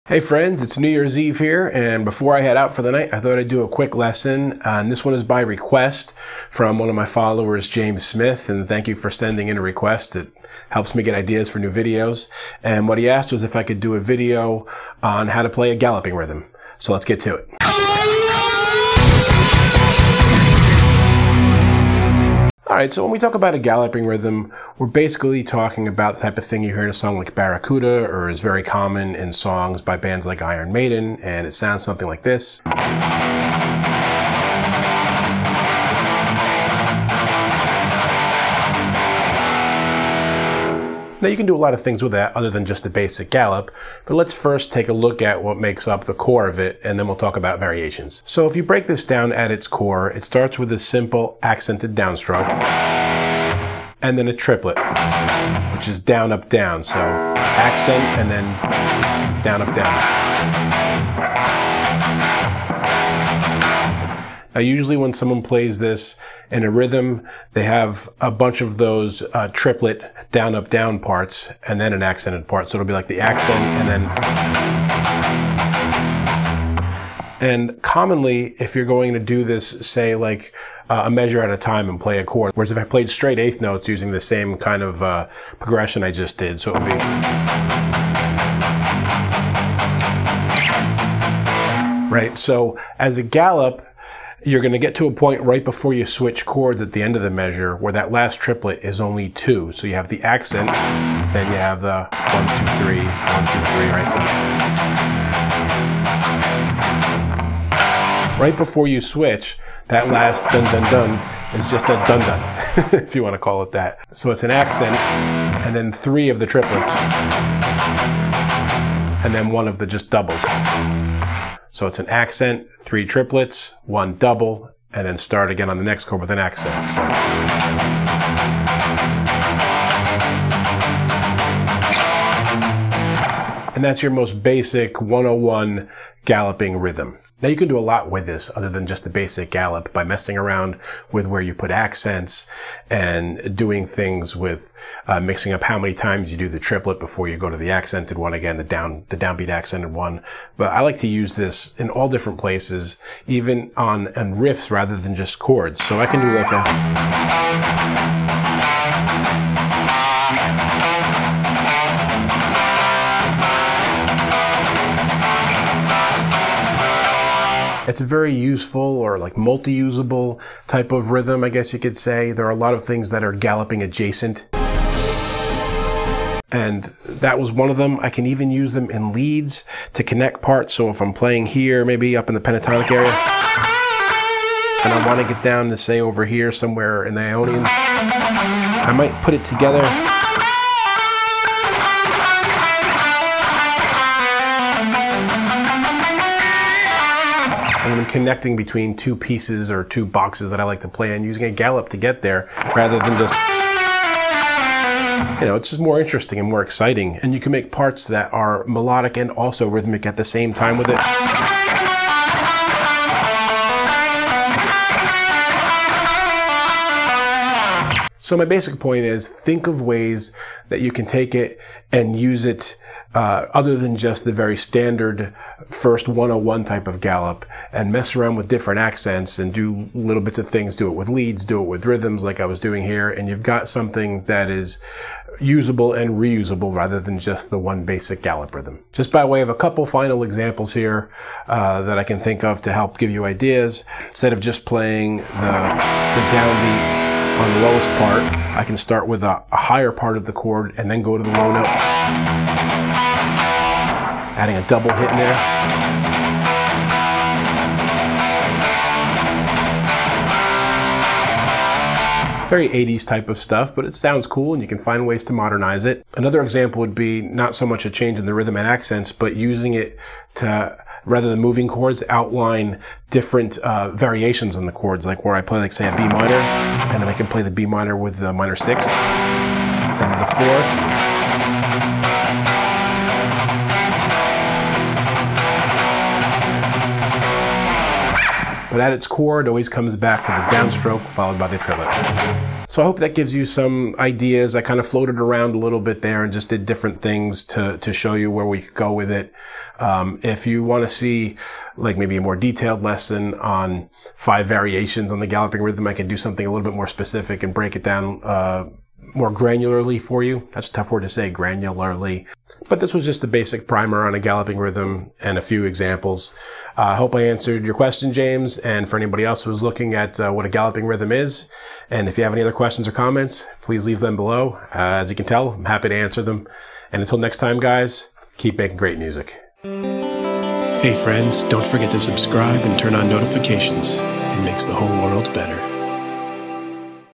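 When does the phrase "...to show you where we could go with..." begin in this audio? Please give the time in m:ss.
4:57.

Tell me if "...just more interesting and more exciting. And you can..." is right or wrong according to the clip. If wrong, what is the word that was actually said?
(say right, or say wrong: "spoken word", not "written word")
right.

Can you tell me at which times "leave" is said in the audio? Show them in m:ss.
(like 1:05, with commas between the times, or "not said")
5:23.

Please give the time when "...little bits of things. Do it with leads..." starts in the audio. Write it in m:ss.
3:49.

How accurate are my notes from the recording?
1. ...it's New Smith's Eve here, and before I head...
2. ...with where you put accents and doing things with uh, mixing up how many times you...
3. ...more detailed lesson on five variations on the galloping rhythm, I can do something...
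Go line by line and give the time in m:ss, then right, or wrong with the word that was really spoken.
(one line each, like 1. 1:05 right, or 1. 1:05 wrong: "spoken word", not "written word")
1. 0:00 wrong: "Year", not "Smith"
2. 2:21 right
3. 5:02 right.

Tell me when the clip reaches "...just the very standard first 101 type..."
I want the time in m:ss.
3:43.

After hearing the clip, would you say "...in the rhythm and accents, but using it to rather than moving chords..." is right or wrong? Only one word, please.
right.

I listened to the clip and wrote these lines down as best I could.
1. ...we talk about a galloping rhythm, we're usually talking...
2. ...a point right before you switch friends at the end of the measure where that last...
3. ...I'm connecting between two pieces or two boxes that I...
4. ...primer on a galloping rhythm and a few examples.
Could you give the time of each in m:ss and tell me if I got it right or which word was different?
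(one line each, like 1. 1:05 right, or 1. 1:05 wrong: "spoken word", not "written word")
1. 0:23 wrong: "basically", not "usually"
2. 1:35 wrong: "chords", not "friends"
3. 3:18 right
4. 5:13 right.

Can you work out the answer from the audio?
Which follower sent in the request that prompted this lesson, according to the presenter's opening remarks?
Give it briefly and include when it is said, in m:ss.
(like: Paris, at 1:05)
James Smith, at 0:07.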